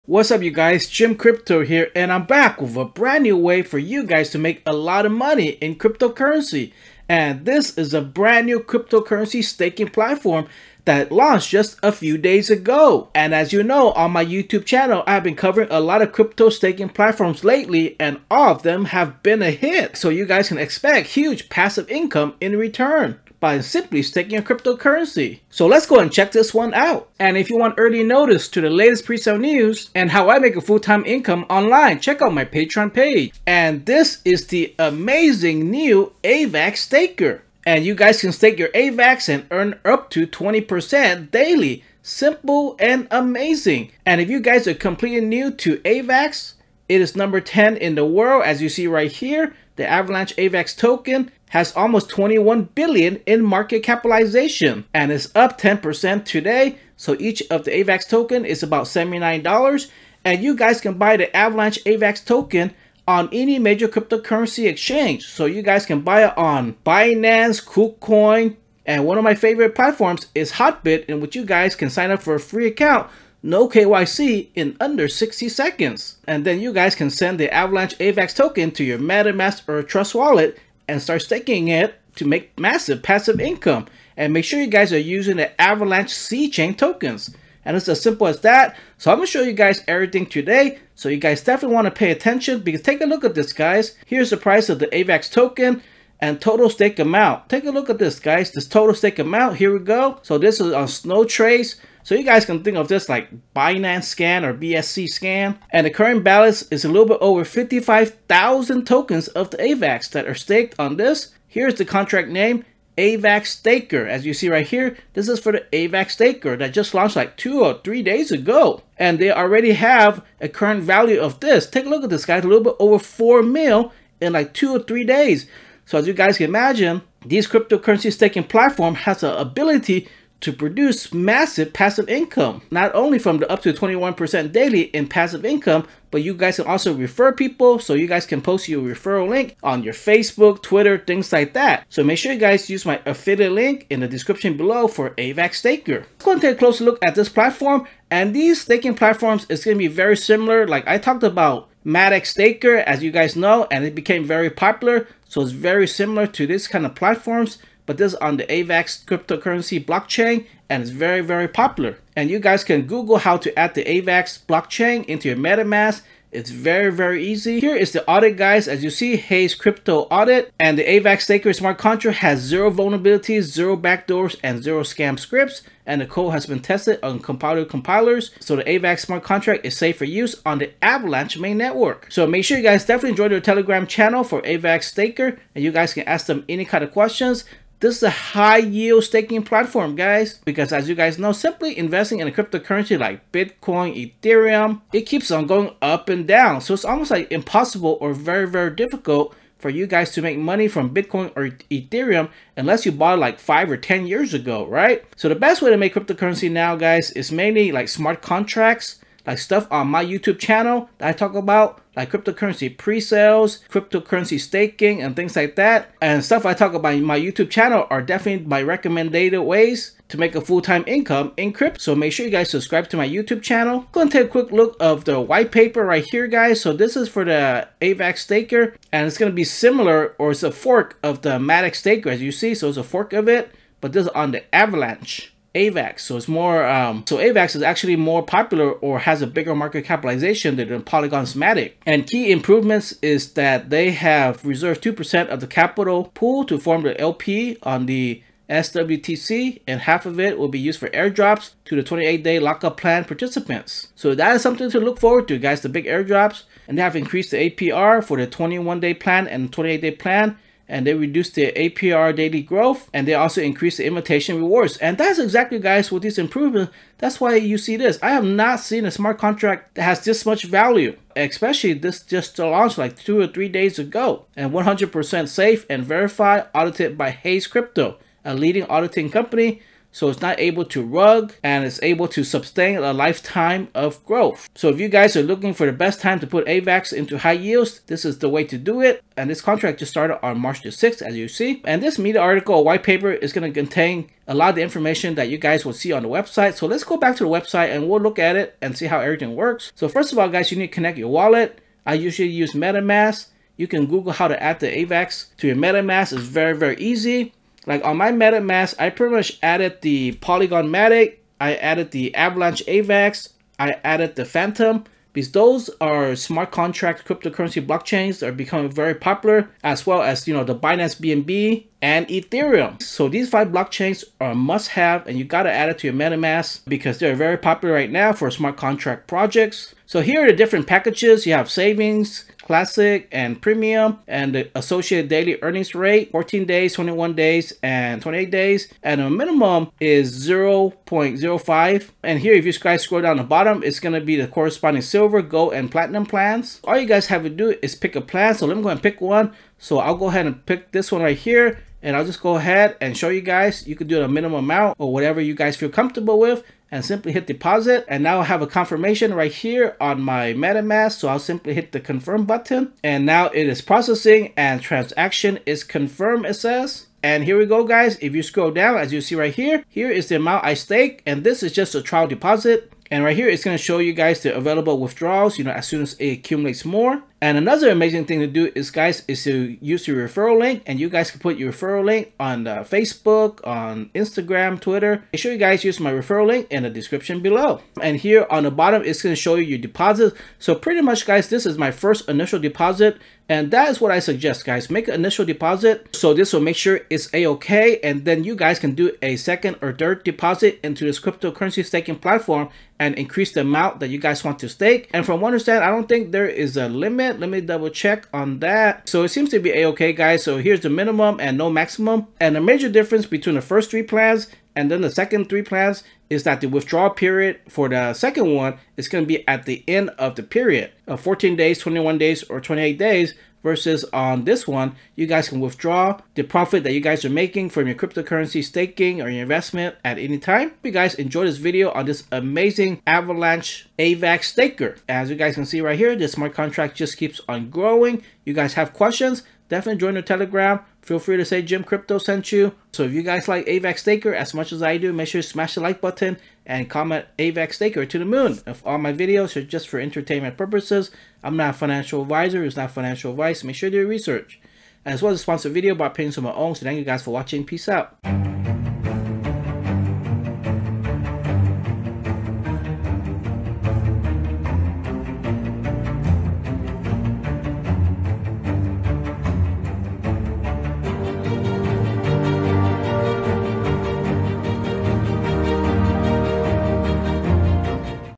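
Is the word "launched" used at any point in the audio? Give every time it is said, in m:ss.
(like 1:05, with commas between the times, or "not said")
0:11, 1:56, 4:32.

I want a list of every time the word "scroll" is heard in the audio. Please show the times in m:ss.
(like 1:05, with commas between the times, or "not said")
5:42, 6:08.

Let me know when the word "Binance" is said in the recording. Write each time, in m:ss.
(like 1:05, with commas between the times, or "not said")
1:06, 1:43, 5:20.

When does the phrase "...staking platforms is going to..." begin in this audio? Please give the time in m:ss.
2:28.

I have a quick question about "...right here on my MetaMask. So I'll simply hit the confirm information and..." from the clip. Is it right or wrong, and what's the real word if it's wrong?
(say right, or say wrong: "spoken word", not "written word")
wrong: "button", not "information".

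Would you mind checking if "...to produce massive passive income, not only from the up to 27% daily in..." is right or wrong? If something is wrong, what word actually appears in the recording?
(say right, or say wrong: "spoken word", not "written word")
wrong: "21", not "27".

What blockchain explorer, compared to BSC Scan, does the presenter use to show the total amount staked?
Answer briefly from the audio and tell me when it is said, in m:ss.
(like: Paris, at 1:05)
Snow Trace, at 1:40.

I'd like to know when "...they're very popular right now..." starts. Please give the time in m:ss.
5:26.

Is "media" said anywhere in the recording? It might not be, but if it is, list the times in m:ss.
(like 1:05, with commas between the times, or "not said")
4:51.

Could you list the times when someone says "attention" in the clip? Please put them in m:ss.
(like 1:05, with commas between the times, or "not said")
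1:32.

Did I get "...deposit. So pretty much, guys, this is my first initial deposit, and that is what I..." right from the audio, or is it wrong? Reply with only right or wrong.
right.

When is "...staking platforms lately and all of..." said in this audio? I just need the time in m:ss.
0:16.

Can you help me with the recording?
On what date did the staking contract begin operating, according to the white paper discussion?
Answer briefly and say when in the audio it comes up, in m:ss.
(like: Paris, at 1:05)
March 6th, at 4:50.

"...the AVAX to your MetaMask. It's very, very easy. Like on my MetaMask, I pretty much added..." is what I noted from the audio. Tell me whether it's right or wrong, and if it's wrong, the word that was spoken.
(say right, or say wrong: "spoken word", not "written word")
right.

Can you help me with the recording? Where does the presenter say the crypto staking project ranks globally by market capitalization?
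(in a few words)
number 10.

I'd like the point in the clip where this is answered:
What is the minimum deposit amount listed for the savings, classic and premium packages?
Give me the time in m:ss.
5:40.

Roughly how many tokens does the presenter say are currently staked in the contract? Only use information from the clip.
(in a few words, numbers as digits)
55,000.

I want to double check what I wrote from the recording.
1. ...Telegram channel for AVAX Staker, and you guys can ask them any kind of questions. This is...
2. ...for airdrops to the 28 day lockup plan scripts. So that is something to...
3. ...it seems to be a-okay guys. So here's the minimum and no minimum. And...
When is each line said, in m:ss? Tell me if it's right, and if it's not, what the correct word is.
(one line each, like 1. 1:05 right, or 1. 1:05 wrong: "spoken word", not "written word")
1. 3:03 right
2. 4:10 wrong: "participants", not "scripts"
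3. 6:49 wrong: "maximum", not "minimum".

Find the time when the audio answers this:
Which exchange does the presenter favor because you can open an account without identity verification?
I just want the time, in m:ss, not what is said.
1:10.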